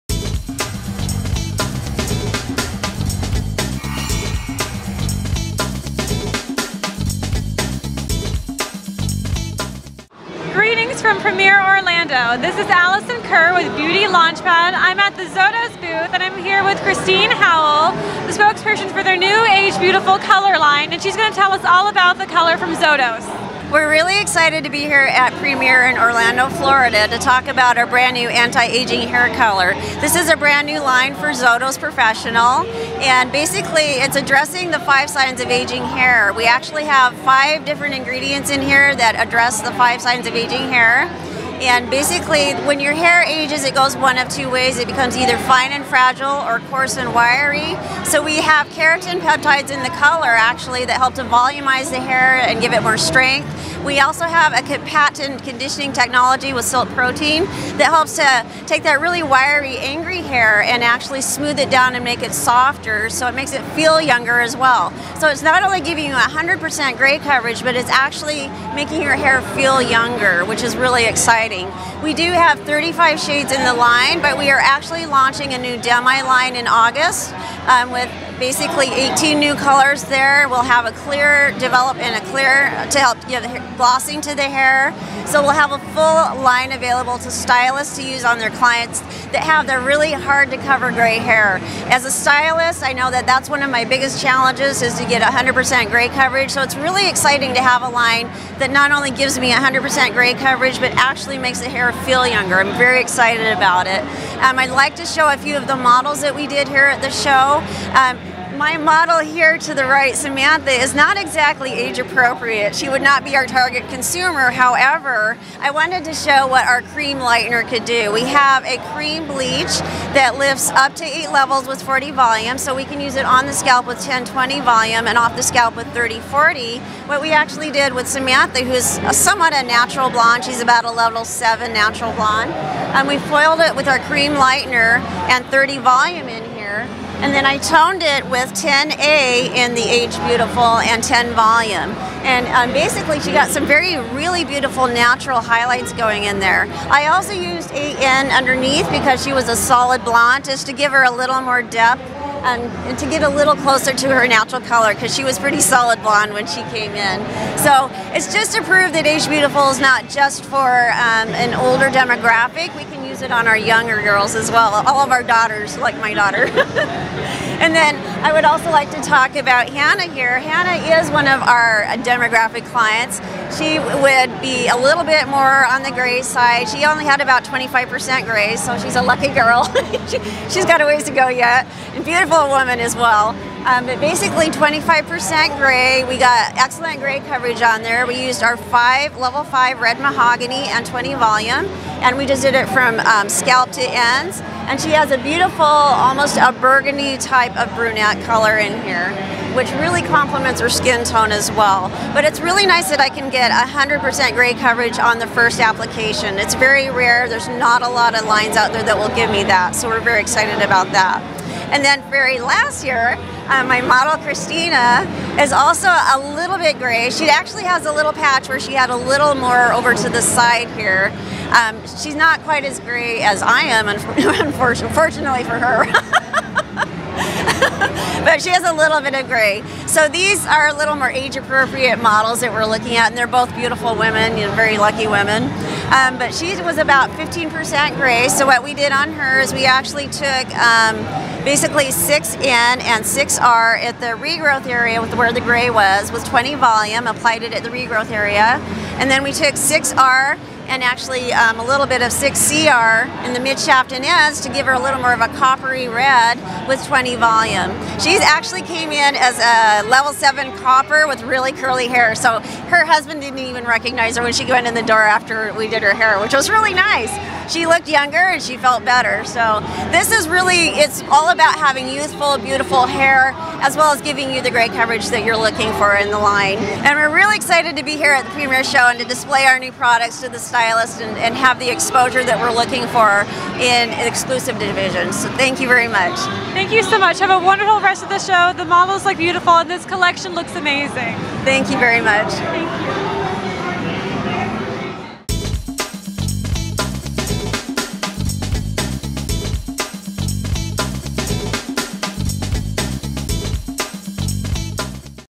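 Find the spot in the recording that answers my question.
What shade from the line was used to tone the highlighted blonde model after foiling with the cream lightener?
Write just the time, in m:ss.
2:18.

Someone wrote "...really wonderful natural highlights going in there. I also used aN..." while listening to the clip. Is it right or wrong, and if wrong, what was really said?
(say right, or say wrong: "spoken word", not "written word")
wrong: "beautiful", not "wonderful".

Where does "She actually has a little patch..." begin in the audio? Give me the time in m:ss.
3:37.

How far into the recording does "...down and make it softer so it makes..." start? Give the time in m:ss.
1:01.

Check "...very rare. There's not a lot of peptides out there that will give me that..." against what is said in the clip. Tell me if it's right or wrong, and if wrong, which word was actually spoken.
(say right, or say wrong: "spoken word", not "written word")
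wrong: "lines", not "peptides".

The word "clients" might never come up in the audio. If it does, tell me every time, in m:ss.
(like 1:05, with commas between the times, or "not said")
1:28, 2:52.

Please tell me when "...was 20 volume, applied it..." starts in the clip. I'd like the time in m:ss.
4:06.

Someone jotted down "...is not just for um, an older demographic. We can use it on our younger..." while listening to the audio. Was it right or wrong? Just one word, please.
right.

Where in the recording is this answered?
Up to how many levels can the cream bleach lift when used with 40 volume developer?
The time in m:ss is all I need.
2:01.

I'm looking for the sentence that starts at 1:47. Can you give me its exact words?
Um, my model here to the right, Samantha, is not exactly age appropriate.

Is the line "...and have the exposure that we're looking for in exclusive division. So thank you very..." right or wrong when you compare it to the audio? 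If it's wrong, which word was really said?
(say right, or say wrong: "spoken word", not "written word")
right.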